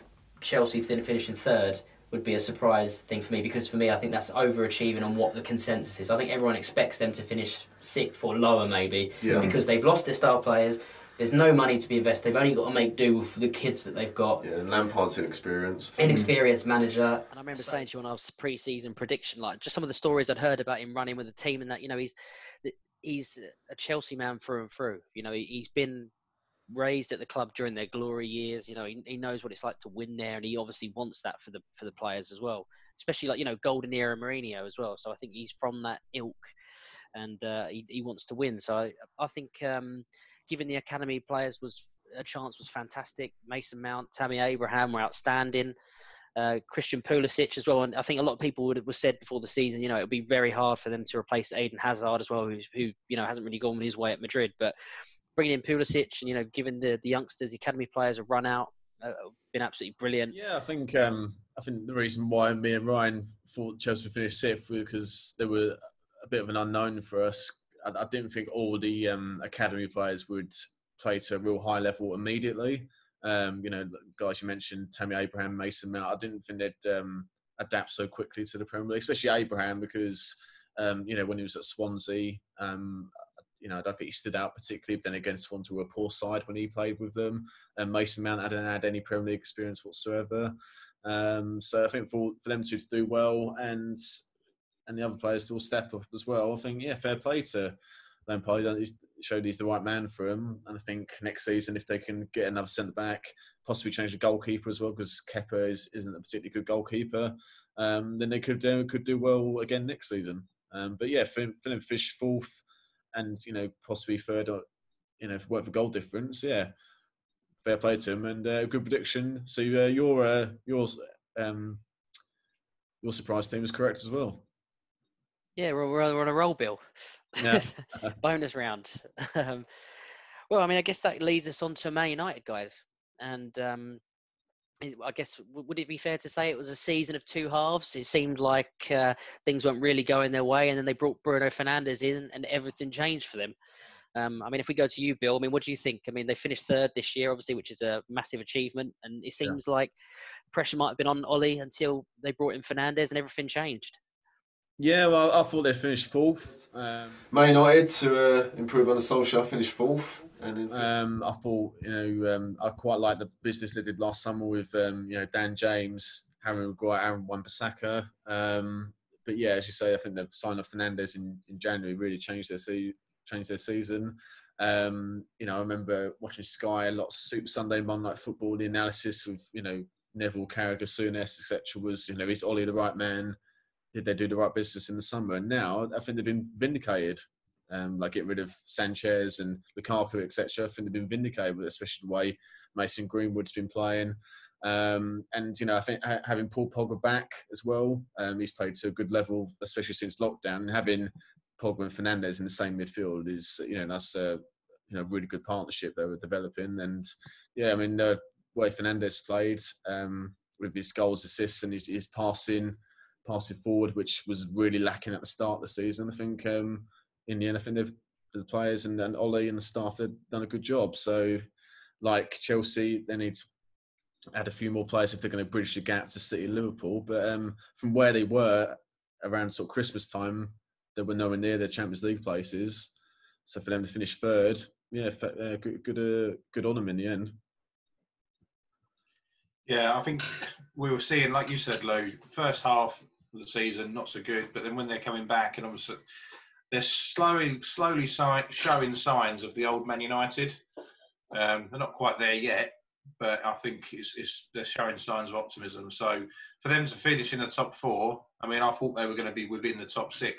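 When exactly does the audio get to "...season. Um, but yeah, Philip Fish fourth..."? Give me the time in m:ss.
1:50.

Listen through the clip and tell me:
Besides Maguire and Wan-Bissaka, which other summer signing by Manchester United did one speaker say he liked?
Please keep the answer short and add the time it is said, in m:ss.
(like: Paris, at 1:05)
Dan James, at 2:45.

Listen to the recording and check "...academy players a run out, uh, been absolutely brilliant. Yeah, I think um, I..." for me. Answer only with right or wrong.
right.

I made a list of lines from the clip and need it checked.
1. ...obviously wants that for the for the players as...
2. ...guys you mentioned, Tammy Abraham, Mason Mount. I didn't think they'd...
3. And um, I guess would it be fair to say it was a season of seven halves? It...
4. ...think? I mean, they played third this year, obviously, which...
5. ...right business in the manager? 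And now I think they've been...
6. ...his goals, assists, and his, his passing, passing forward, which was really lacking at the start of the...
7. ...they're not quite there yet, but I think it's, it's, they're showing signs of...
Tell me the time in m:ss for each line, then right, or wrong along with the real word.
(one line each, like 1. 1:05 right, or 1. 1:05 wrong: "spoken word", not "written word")
1. 0:30 right
2. 1:14 right
3. 2:13 wrong: "two", not "seven"
4. 2:25 wrong: "finished", not "played"
5. 3:04 wrong: "summer", not "manager"
6. 3:30 right
7. 4:11 right.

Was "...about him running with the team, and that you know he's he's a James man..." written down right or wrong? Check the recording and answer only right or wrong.
wrong.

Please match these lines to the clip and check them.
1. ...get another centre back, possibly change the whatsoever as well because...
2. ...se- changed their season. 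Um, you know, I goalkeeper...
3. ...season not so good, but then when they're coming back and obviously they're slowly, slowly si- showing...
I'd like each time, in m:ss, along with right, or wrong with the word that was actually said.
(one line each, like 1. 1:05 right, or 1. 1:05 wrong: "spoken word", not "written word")
1. 1:42 wrong: "goalkeeper", not "whatsoever"
2. 2:52 wrong: "remember", not "goalkeeper"
3. 4:03 right.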